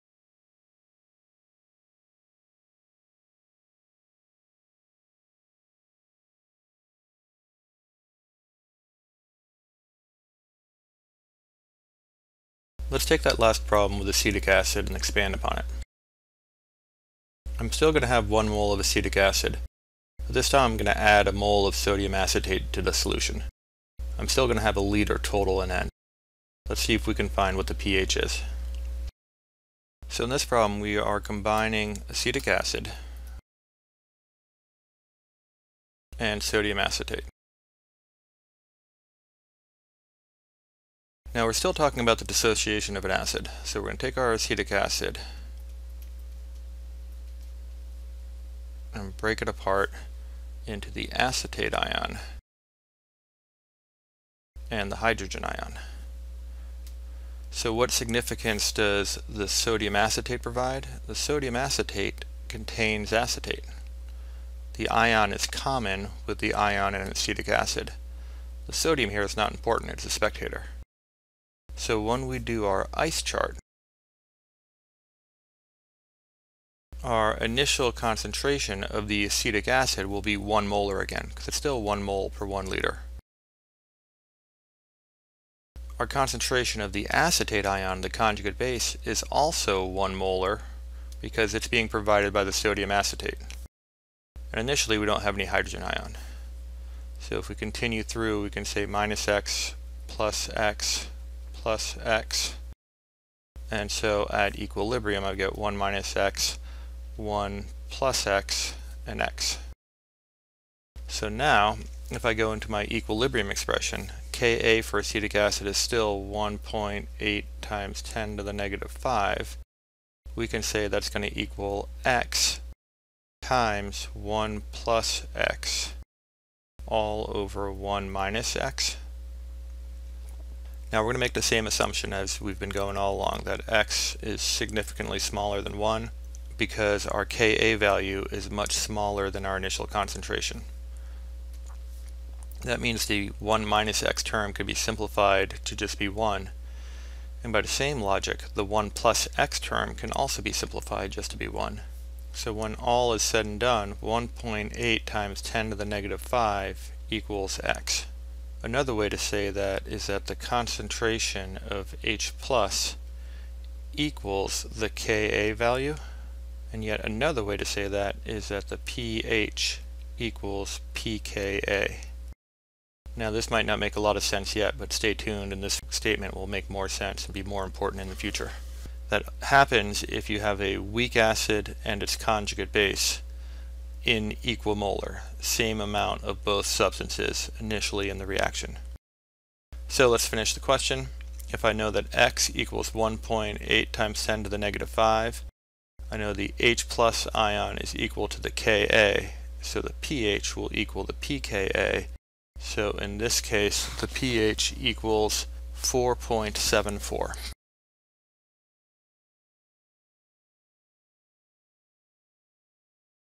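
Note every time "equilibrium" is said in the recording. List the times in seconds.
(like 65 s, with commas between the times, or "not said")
104 s, 112 s.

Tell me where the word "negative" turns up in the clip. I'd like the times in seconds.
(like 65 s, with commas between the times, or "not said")
118 s, 155 s, 194 s.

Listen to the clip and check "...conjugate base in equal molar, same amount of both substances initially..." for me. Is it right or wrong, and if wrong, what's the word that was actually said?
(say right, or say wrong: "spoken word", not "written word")
right.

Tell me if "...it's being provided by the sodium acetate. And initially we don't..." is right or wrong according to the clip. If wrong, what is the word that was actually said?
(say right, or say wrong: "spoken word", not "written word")
right.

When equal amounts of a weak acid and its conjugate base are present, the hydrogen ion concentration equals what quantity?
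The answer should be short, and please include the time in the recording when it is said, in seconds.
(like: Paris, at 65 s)
the Ka value, at 164 s.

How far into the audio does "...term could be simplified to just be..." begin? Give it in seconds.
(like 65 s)
144 s.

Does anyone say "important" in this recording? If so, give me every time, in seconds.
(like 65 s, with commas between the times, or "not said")
69 s, 177 s.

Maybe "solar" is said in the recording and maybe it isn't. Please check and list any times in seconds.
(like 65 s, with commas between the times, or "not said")
not said.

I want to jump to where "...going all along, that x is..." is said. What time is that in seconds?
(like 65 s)
132 s.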